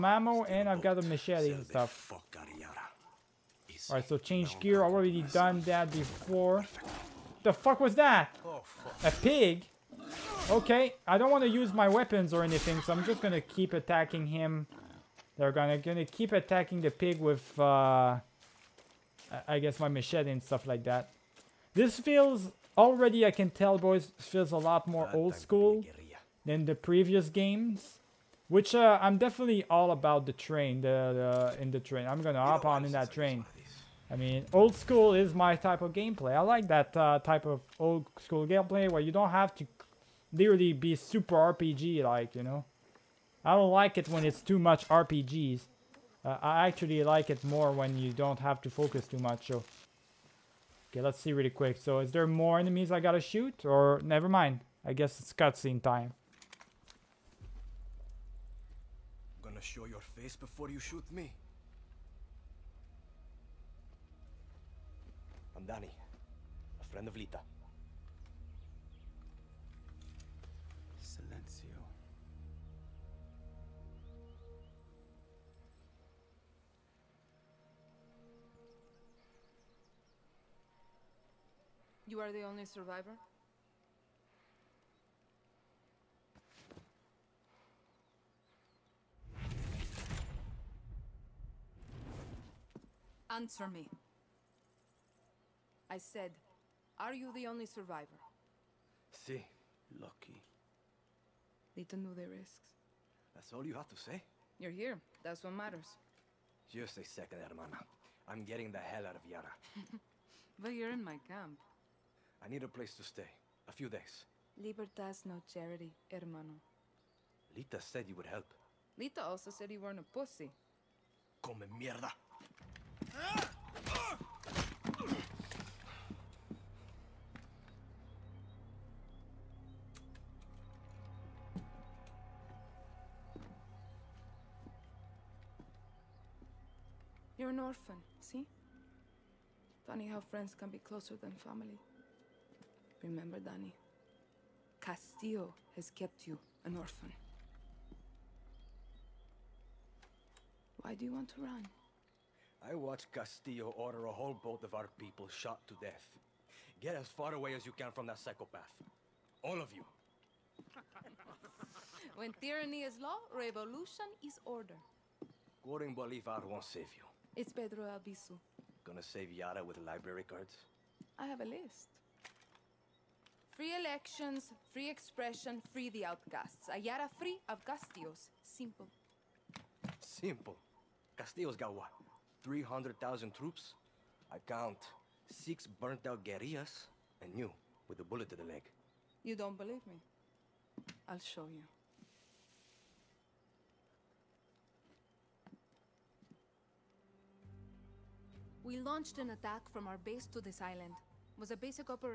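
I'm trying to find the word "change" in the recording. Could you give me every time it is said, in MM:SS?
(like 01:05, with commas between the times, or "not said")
00:04.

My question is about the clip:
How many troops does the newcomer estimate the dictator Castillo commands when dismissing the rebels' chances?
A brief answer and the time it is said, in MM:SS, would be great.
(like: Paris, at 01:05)
300,000, at 03:02.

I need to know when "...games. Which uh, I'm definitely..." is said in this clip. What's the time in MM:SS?
00:27.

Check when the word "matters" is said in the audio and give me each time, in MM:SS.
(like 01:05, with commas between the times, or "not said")
01:45.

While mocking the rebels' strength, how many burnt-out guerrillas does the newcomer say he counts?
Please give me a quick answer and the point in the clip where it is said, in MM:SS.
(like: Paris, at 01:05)
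6, at 03:05.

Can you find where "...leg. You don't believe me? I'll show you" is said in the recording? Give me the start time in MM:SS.
03:08.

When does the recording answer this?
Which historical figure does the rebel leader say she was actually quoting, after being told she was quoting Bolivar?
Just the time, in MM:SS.
02:47.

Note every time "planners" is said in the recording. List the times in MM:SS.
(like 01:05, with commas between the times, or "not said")
not said.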